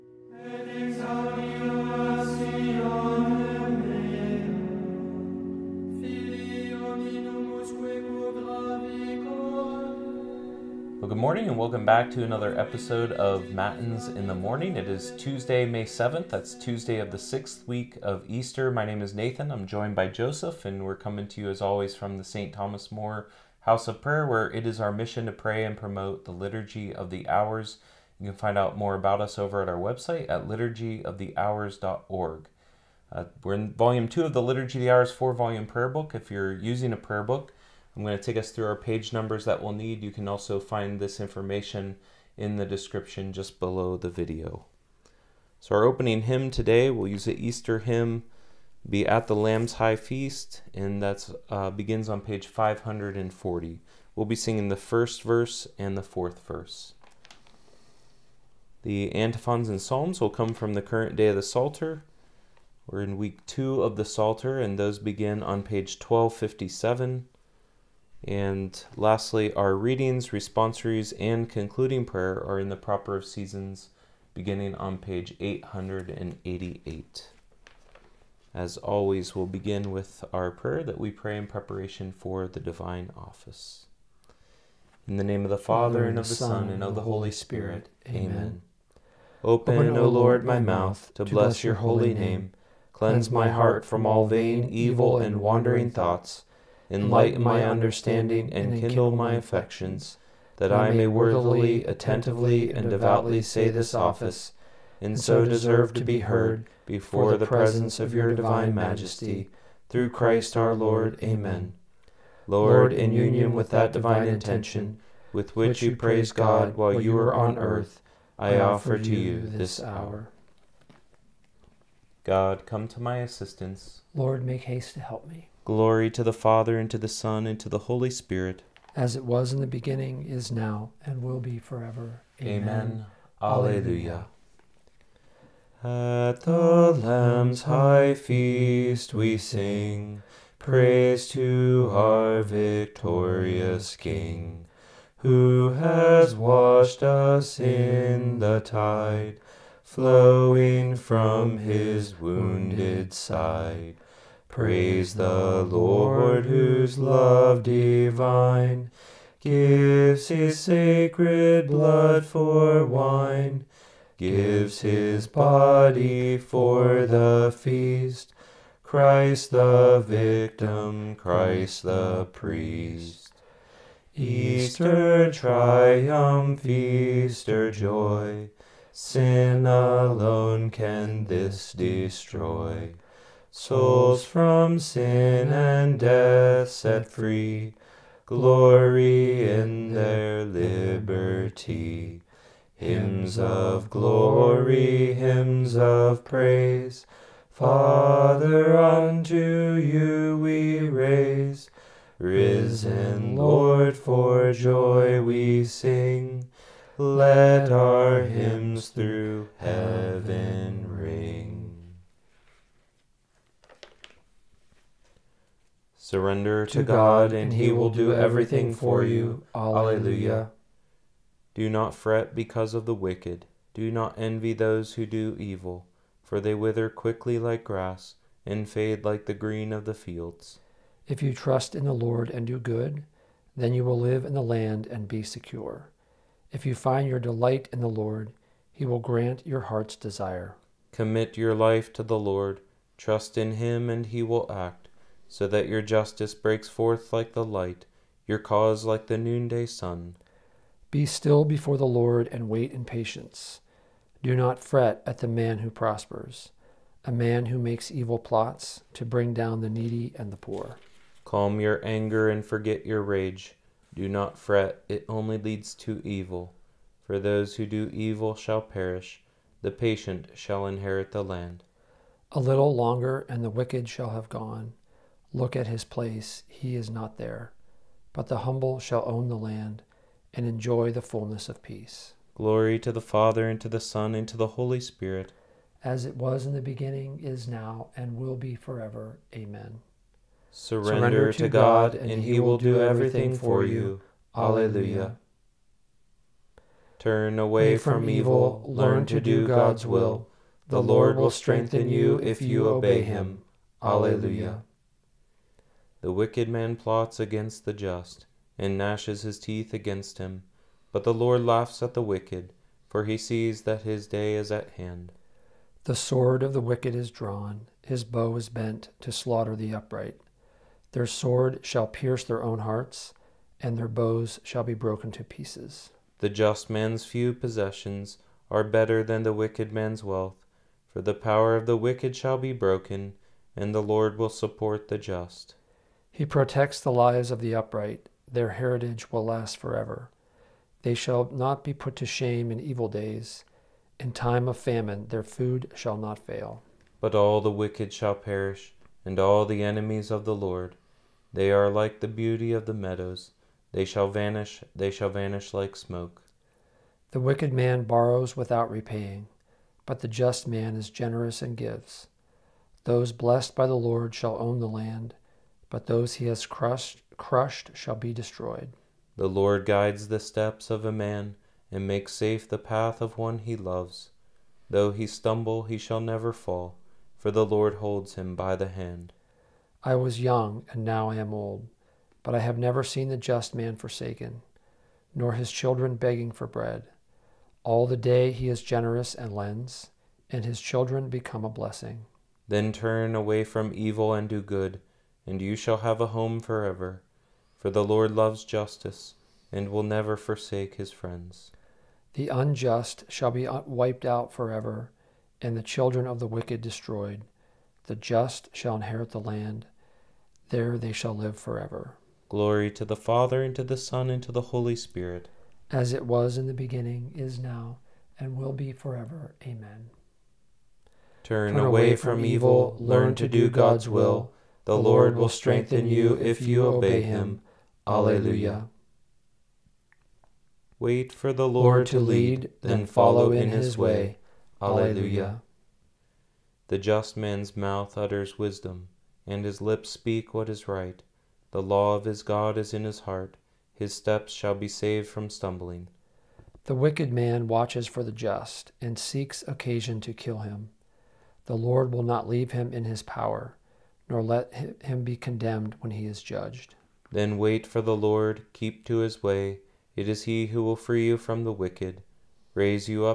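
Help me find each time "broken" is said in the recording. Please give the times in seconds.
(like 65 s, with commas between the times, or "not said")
324 s, 332 s.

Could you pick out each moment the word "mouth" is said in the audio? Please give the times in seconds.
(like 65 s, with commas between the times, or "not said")
90 s, 437 s.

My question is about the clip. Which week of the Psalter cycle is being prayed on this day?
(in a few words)
Week two.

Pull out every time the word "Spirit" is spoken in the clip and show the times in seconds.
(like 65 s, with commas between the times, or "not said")
87 s, 128 s, 284 s, 414 s.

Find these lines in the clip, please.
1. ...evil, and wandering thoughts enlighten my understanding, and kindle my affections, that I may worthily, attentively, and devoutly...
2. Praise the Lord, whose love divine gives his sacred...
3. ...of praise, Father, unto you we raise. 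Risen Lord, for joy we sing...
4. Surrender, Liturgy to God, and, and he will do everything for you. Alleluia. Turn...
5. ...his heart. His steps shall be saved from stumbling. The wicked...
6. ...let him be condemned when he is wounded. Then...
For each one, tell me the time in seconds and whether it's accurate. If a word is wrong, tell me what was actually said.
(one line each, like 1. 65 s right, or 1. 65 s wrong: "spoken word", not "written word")
1. 94 s right
2. 154 s right
3. 195 s right
4. 290 s wrong: "Surrender", not "Liturgy"
5. 442 s right
6. 454 s wrong: "judged", not "wounded".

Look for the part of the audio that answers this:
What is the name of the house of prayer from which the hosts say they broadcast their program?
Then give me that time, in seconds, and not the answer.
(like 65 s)
22 s.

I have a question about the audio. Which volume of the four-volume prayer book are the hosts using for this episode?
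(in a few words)
Volume two.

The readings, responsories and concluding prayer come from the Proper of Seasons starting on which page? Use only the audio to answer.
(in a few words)
888.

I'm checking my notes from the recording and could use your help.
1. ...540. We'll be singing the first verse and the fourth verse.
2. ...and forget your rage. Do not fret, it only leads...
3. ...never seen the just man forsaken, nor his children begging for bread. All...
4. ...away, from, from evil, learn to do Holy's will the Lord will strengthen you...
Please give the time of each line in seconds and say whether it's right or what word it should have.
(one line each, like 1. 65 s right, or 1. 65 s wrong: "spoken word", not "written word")
1. 52 s right
2. 262 s right
3. 382 s right
4. 421 s wrong: "God", not "Holy".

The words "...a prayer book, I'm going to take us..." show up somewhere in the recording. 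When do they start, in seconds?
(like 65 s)
36 s.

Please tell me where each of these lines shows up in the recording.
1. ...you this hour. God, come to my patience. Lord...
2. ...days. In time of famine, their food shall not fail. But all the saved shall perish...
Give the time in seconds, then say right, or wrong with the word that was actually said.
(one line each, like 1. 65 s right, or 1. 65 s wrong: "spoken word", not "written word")
1. 119 s wrong: "assistance", not "patience"
2. 342 s wrong: "wicked", not "saved".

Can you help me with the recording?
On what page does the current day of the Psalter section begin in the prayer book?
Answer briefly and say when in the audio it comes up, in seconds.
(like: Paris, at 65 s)
1257, at 66 s.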